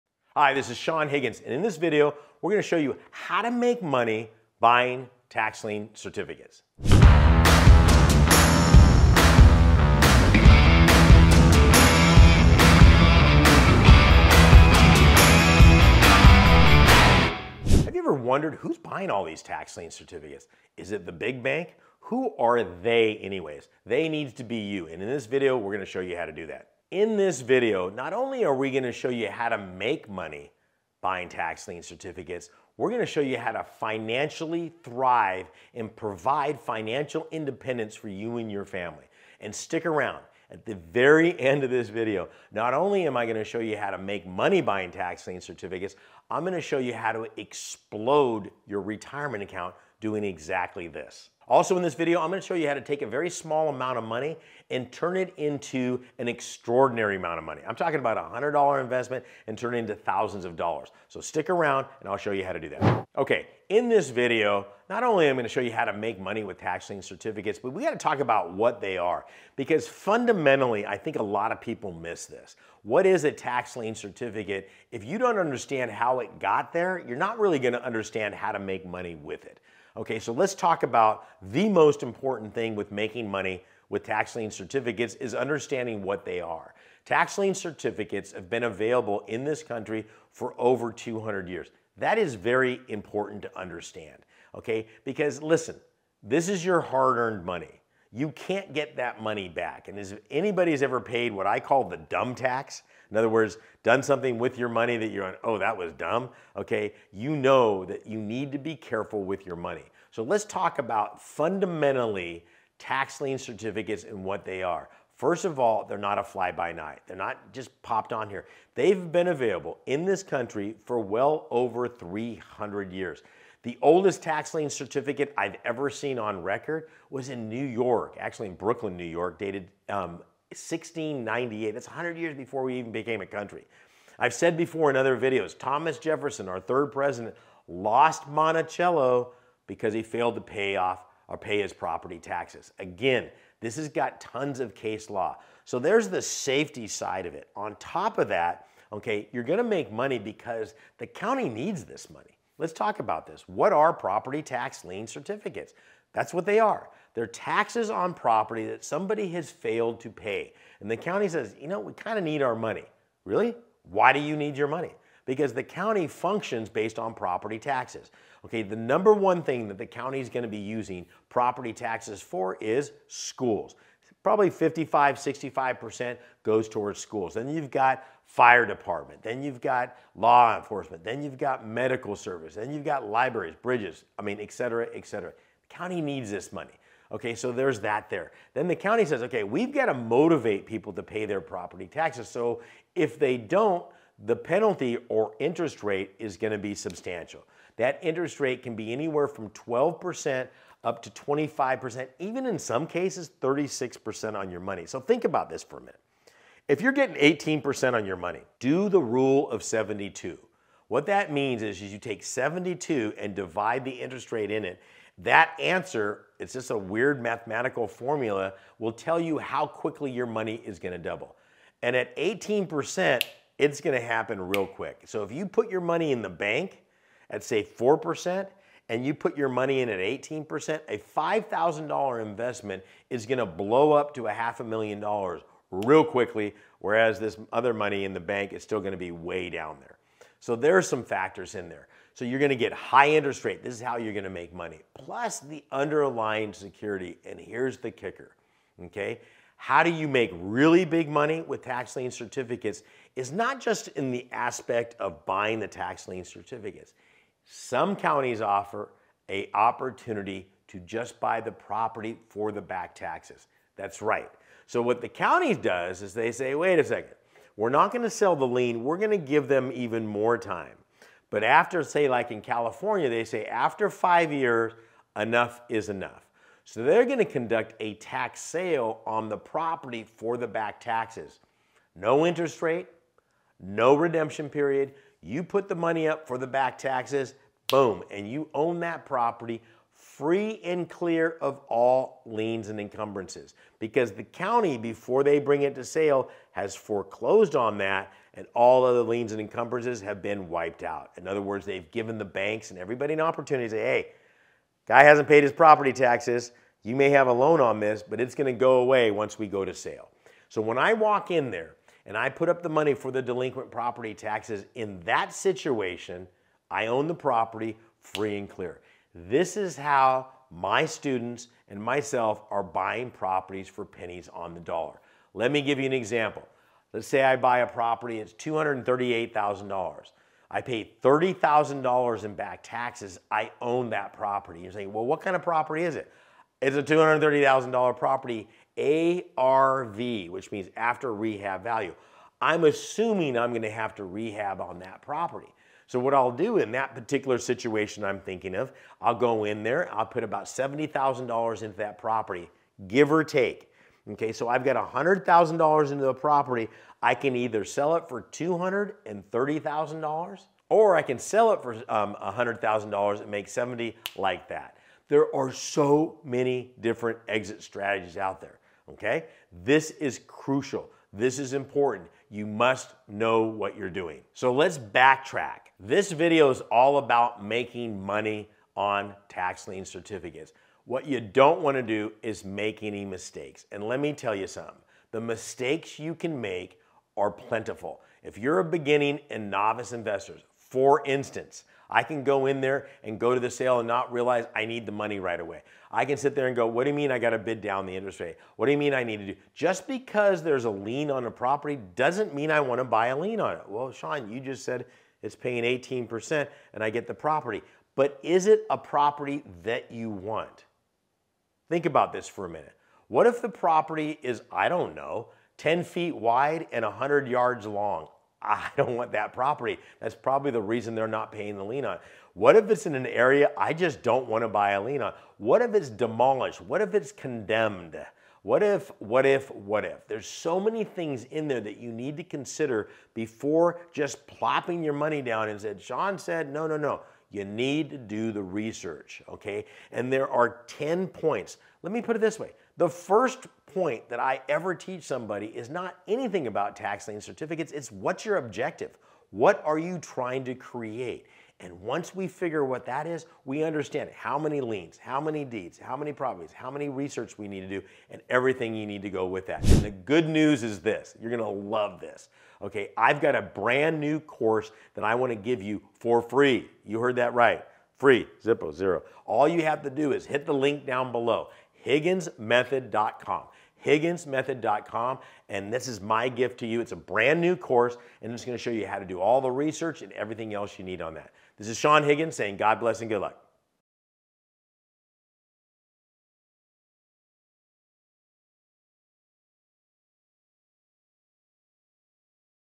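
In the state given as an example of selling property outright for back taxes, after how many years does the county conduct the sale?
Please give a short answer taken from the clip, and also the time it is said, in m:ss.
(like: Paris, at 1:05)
5 years, at 4:33.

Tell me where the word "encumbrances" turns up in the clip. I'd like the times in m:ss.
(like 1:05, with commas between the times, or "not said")
4:52, 4:59.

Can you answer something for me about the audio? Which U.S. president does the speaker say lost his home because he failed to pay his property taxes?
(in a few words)
Thomas Jefferson.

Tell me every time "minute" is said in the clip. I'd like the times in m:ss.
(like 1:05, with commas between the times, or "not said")
3:25, 6:52.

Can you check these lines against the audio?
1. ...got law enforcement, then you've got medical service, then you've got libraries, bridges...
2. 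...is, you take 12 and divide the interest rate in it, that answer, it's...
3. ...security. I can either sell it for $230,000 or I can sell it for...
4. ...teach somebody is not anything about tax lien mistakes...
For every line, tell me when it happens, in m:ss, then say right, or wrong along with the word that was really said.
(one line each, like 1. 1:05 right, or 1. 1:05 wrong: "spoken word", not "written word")
1. 2:59 right
2. 3:31 wrong: "72", not "12"
3. 5:56 wrong: "property", not "security"
4. 7:24 wrong: "certificates", not "mistakes".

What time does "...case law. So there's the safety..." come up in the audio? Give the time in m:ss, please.
2:24.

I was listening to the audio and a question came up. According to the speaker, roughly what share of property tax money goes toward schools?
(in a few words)
55-65%.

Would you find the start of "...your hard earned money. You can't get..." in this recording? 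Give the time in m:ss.
1:36.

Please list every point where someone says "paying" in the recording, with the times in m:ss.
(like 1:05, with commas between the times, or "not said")
6:45, 7:01.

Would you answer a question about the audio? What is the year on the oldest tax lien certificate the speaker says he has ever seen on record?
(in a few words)
1698.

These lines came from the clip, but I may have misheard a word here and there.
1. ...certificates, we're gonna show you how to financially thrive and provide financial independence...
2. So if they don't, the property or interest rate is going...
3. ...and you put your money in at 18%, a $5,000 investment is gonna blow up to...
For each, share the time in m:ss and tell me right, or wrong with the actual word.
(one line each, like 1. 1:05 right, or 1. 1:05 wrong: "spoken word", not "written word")
1. 0:31 right
2. 3:12 wrong: "penalty", not "property"
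3. 3:48 right.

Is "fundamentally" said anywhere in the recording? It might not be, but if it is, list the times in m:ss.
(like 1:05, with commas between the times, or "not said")
1:09, 1:51.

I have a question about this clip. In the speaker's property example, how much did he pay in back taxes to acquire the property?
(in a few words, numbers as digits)
$30,000.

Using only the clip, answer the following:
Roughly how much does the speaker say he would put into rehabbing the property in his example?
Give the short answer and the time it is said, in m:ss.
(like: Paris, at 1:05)
$70,000, at 5:50.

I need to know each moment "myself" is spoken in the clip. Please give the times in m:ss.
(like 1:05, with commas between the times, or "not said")
5:21.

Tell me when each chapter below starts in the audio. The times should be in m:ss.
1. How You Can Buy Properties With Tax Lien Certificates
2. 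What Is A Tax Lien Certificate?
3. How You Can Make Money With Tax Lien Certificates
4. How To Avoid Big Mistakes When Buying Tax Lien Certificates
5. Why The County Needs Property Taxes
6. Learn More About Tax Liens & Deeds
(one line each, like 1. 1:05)
1. 4:07
2. 1:03
3. 3:08
4. 6:14
5. 2:28
6. 7:40.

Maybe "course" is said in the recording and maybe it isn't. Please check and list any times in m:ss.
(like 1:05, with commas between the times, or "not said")
7:44, 7:57.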